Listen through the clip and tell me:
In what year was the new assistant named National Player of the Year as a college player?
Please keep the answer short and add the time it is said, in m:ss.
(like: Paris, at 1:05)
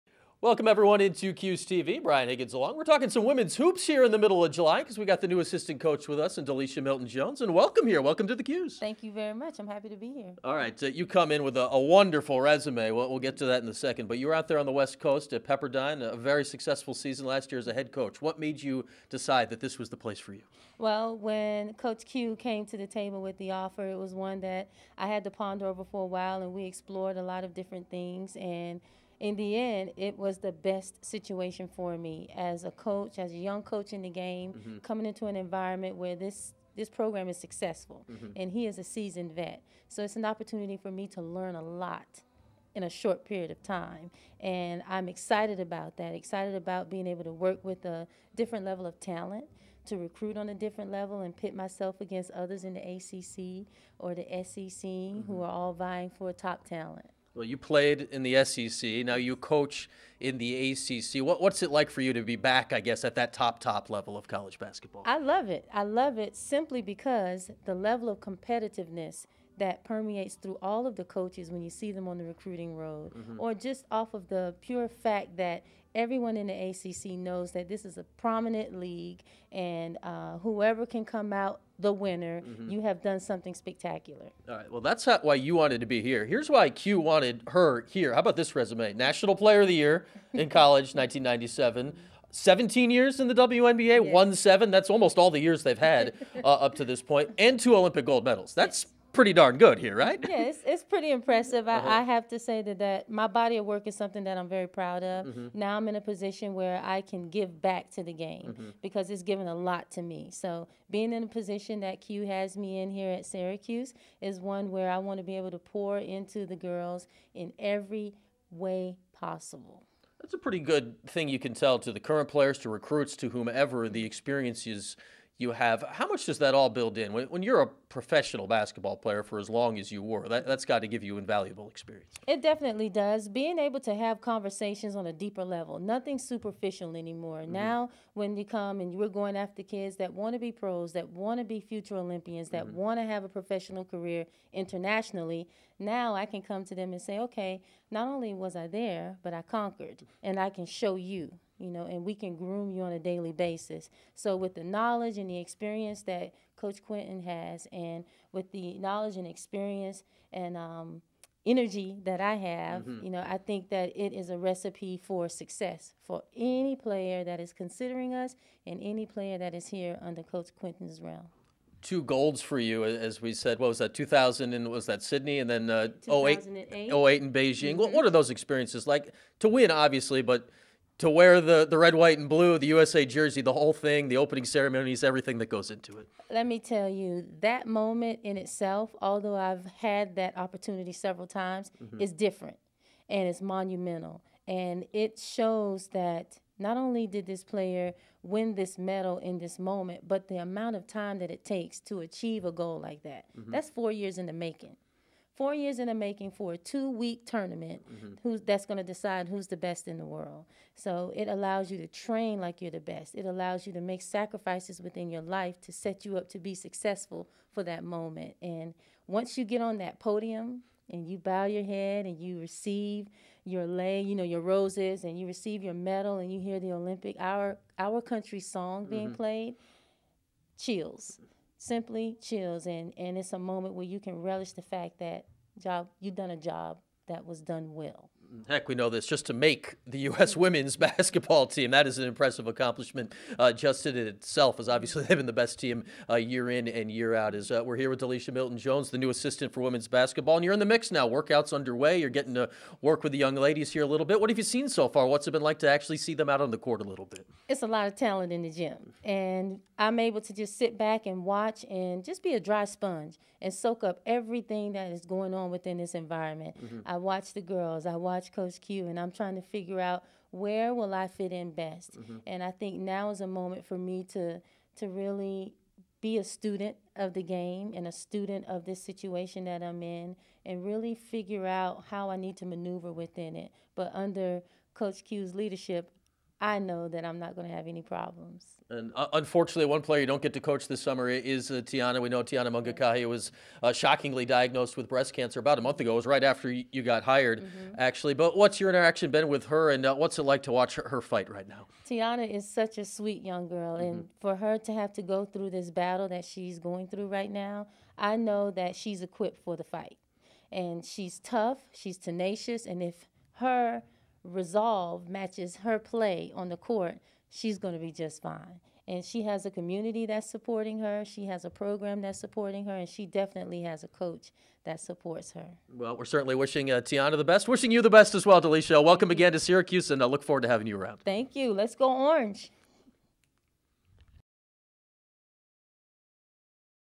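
1997, at 1:30.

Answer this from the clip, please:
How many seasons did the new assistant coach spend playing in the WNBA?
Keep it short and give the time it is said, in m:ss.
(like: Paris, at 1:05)
17, at 1:32.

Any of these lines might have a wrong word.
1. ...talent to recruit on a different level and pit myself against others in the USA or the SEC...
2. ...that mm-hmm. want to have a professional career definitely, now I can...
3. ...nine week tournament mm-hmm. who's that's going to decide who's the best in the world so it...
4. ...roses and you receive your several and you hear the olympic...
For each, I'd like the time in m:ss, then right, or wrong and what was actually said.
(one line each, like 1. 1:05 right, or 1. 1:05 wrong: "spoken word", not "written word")
1. 0:49 wrong: "ACC", not "USA"
2. 2:22 wrong: "internationally", not "definitely"
3. 3:26 wrong: "two", not "nine"
4. 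3:44 wrong: "medal", not "several".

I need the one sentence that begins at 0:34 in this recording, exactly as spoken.
coming into an environment where this this program is successful, mm-hmm.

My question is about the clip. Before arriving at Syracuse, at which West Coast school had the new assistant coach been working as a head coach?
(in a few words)
Pepperdine.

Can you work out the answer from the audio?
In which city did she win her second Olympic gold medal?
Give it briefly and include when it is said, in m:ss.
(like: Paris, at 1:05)
Beijing, at 2:56.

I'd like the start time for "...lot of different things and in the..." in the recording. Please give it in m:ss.
0:27.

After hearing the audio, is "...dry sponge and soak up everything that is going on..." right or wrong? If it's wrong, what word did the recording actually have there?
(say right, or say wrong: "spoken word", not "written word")
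right.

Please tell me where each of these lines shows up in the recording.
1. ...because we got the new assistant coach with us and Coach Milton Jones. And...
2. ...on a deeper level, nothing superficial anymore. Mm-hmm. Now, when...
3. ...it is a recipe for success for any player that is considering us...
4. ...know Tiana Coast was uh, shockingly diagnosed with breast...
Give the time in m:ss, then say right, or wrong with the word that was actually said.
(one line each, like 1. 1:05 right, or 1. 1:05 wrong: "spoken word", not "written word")
1. 0:04 wrong: "DeLisha", not "Coach"
2. 2:14 right
3. 2:43 right
4. 4:52 wrong: "Mangakahia", not "Coast".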